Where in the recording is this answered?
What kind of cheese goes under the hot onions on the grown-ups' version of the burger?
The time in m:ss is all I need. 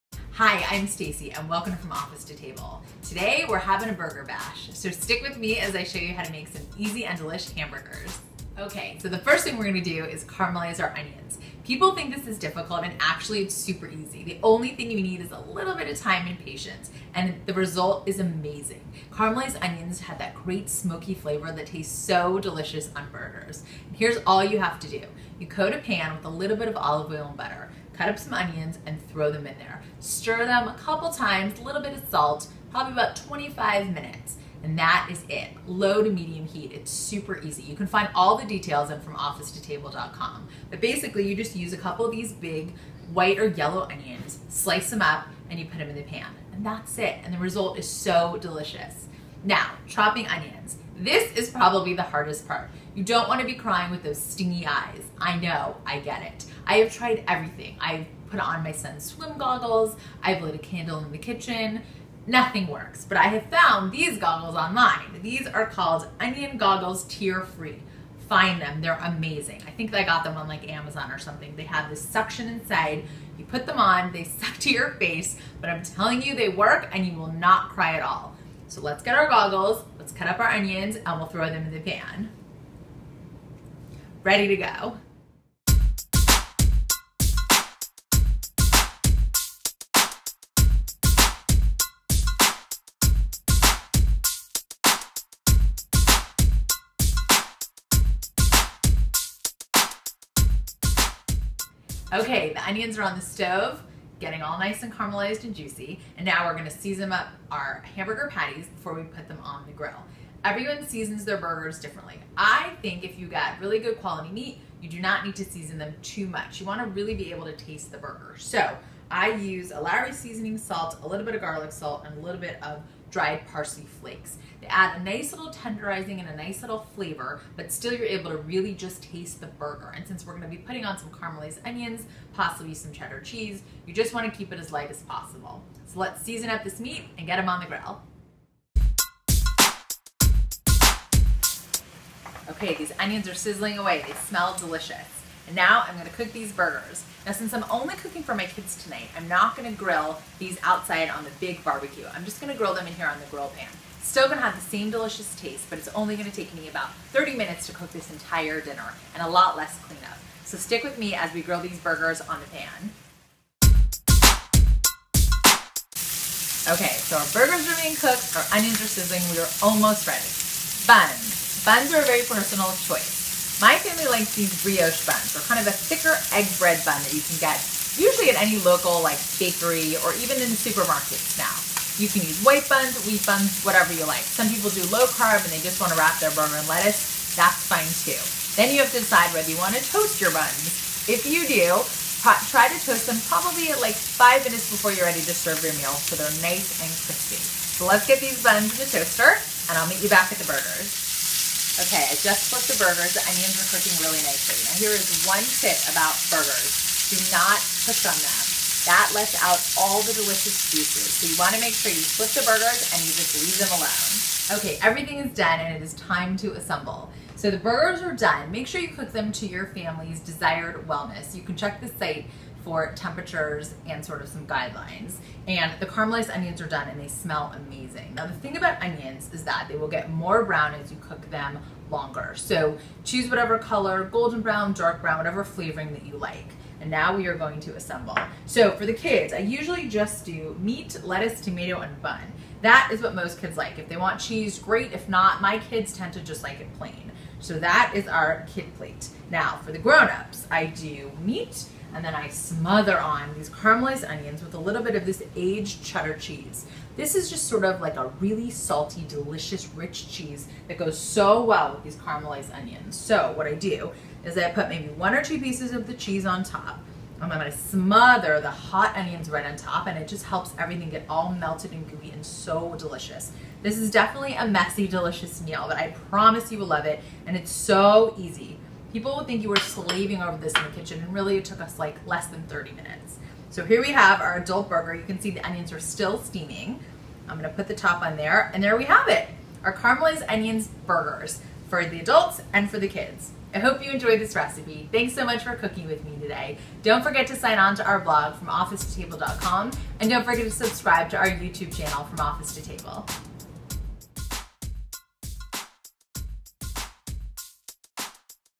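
4:15.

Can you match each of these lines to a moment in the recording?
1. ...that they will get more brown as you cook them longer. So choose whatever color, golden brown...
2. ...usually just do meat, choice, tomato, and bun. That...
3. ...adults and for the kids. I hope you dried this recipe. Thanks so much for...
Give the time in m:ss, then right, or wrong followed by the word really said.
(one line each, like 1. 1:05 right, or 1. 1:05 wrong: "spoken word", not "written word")
1. 3:49 right
2. 3:59 wrong: "lettuce", not "choice"
3. 4:52 wrong: "enjoyed", not "dried".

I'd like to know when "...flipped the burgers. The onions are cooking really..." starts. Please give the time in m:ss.
3:22.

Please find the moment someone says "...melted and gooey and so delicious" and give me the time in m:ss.
4:31.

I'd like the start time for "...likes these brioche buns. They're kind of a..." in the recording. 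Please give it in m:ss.
2:54.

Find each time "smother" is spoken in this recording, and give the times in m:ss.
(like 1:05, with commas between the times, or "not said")
4:12, 4:27.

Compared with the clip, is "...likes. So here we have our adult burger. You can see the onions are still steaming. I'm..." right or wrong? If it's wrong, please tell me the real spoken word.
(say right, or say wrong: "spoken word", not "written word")
wrong: "minutes", not "likes".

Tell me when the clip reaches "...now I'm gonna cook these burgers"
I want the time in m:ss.
2:25.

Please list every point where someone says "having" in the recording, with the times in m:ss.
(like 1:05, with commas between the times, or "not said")
0:03.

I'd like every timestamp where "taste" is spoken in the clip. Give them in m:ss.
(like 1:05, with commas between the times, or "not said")
0:21, 1:57, 2:09, 2:35.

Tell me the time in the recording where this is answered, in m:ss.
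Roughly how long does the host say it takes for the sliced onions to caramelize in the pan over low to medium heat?
0:33.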